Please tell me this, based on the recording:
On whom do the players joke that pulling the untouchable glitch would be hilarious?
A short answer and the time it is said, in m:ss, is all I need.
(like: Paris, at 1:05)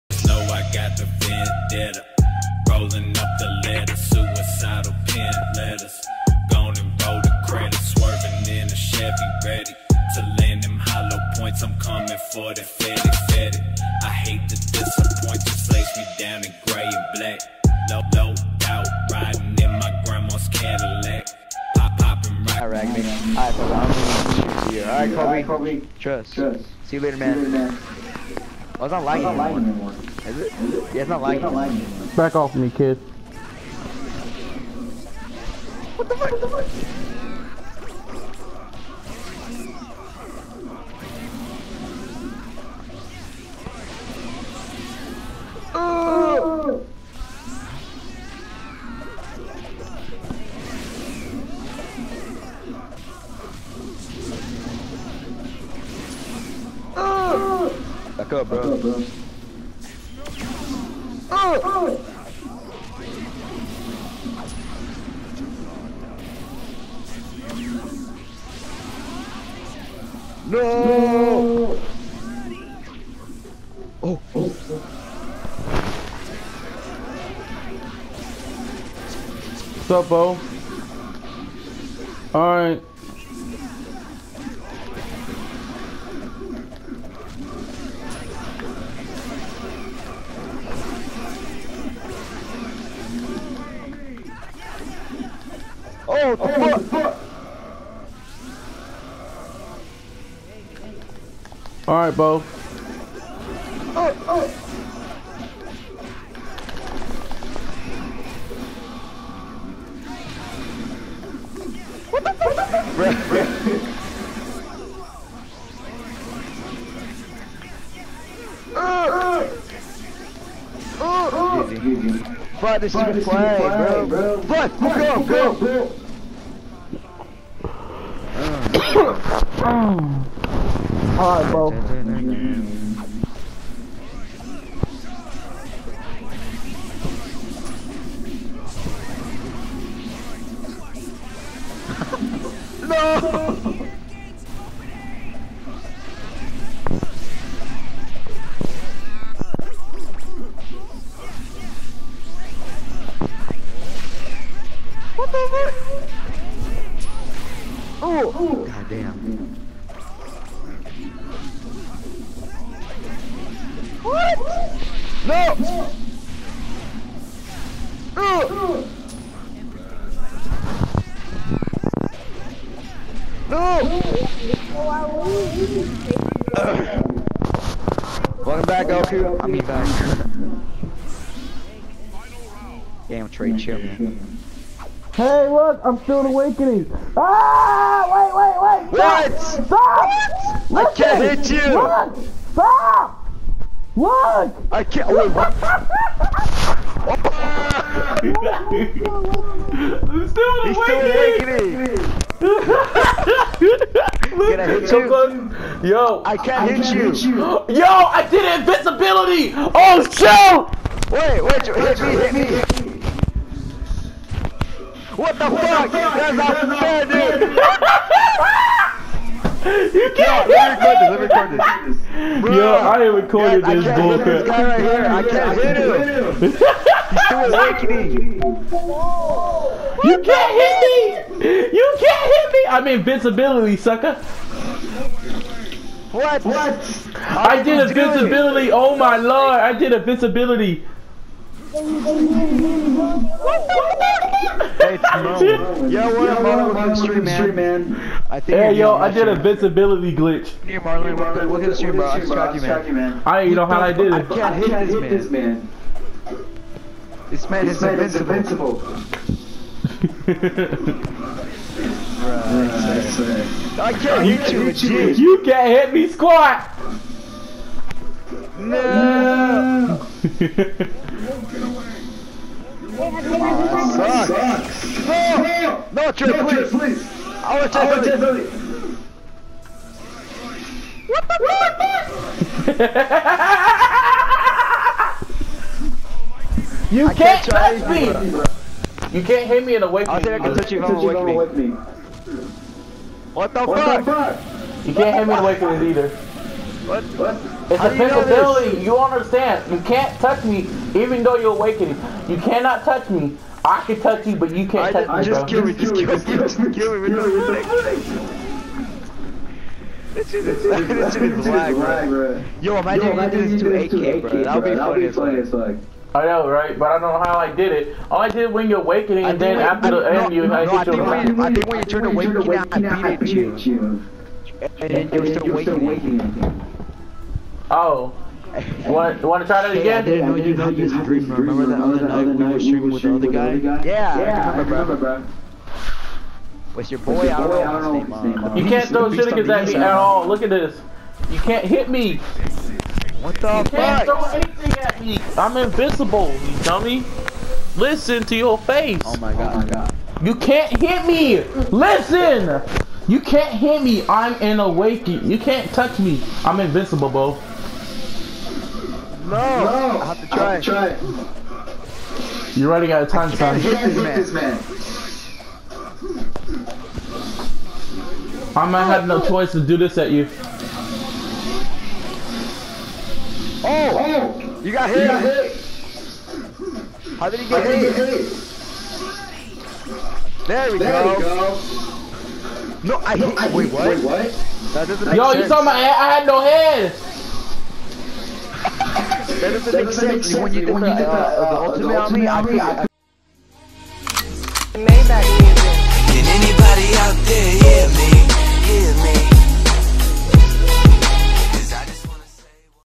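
AK, at 5:14.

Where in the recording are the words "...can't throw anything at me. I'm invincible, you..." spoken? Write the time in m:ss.
5:43.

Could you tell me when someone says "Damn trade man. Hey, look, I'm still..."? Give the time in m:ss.
3:03.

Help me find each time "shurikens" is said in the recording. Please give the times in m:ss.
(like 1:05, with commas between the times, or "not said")
5:39.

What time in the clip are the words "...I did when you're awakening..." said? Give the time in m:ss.
5:18.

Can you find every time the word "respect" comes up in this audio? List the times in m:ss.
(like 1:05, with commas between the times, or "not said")
not said.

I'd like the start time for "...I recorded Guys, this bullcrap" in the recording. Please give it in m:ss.
3:42.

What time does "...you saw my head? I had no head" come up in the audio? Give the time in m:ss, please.
6:25.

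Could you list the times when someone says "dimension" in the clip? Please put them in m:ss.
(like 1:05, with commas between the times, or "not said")
not said.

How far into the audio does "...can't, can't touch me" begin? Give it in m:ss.
4:47.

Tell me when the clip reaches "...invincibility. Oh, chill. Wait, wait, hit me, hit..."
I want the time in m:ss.
3:28.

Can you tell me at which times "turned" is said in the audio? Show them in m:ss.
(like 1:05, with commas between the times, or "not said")
5:21.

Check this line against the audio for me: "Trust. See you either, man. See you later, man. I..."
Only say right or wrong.
wrong.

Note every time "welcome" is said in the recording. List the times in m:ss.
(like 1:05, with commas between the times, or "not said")
2:58, 4:06, 4:11.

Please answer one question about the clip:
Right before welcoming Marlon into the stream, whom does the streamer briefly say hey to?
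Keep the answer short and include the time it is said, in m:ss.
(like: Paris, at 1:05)
Timon, at 4:04.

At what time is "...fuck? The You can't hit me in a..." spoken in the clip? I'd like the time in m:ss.
4:54.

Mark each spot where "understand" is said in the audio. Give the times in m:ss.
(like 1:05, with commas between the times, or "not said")
4:58.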